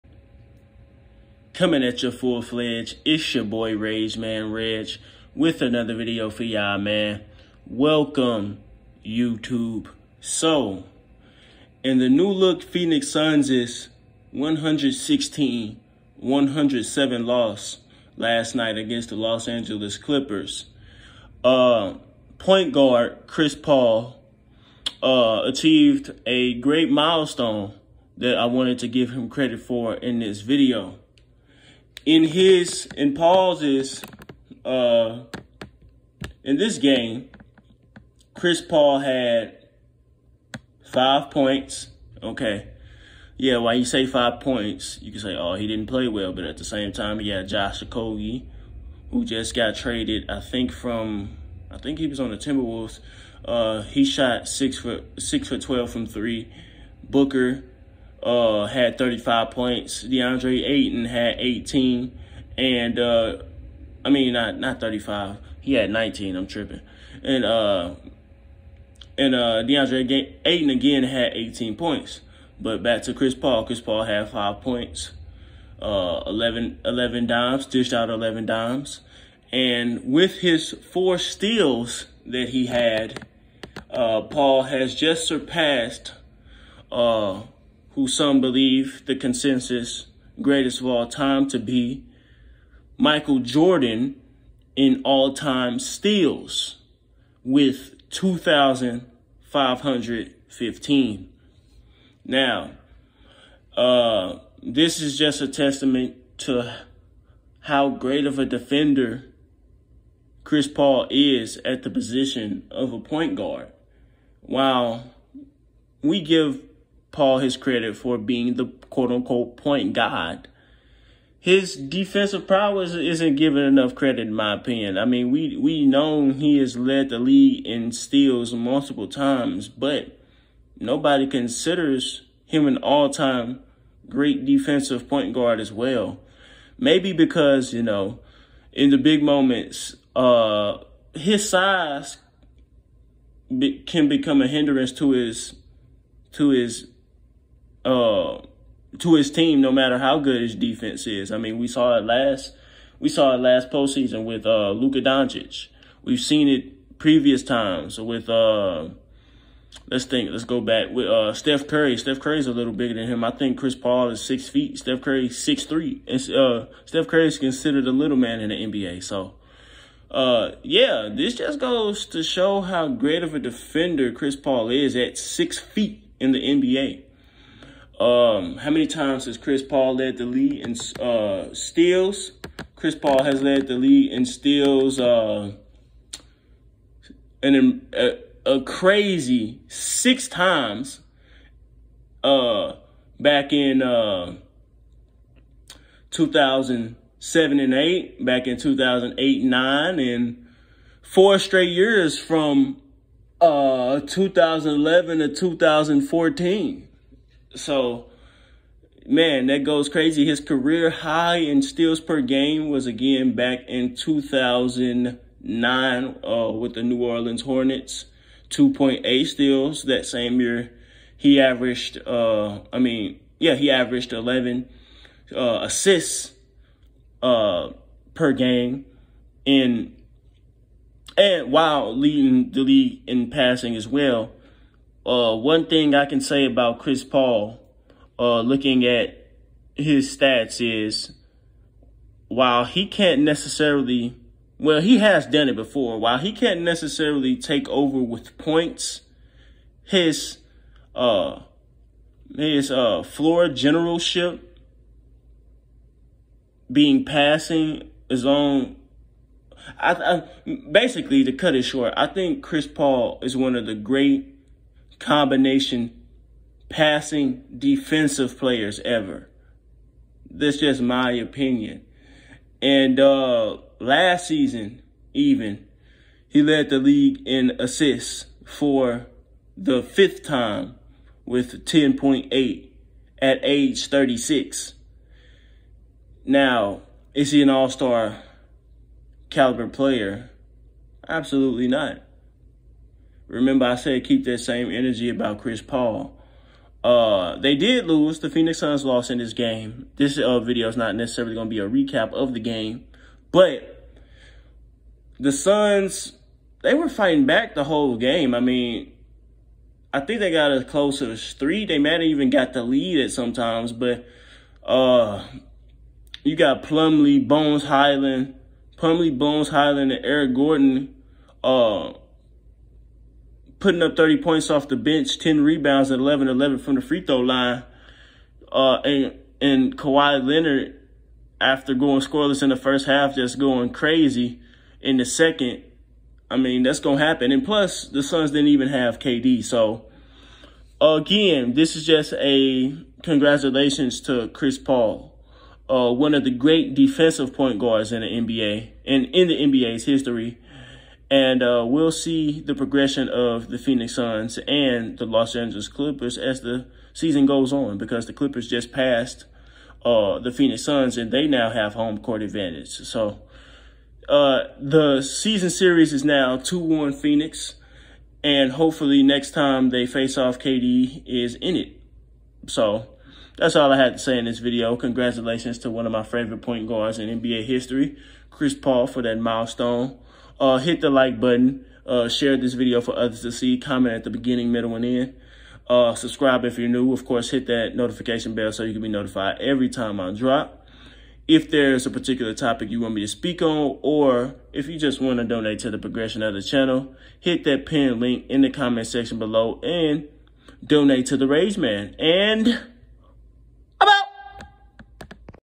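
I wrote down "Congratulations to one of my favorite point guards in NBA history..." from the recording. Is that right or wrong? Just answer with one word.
right.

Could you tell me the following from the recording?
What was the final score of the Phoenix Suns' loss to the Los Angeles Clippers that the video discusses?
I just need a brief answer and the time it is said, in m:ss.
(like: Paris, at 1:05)
116-107, at 0:14.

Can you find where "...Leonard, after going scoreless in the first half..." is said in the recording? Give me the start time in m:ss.
5:30.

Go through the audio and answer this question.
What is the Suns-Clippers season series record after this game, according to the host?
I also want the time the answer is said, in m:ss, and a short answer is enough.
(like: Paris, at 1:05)
2-1 Phoenix, at 6:06.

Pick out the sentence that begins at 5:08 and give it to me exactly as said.
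I mean, I think they got as close as three.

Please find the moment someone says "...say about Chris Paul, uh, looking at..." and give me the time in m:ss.
3:56.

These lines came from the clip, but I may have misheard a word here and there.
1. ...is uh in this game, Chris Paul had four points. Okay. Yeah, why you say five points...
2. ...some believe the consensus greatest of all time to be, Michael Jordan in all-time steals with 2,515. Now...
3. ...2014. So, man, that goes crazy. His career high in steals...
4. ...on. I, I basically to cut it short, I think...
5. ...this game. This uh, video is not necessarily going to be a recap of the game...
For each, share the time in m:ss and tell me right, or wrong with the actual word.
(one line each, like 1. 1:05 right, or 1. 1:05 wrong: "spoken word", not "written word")
1. 0:33 wrong: "five", not "four"
2. 1:28 right
3. 3:25 right
4. 4:18 right
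5. 4:59 right.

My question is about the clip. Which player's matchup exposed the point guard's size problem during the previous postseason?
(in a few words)
Luka Doncic.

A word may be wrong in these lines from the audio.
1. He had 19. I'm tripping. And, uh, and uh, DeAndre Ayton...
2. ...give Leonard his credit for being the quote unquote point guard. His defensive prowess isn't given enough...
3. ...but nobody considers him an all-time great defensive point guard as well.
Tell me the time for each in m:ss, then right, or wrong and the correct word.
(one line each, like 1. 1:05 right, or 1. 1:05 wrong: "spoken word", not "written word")
1. 1:05 right
2. 1:56 wrong: "Paul", not "Leonard"
3. 2:09 right.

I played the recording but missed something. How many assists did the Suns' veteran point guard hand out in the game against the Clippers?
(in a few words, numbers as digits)
11.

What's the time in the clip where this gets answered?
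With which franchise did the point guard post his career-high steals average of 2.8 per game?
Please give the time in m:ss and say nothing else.
3:36.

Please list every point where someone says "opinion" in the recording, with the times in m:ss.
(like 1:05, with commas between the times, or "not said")
2:04, 4:31.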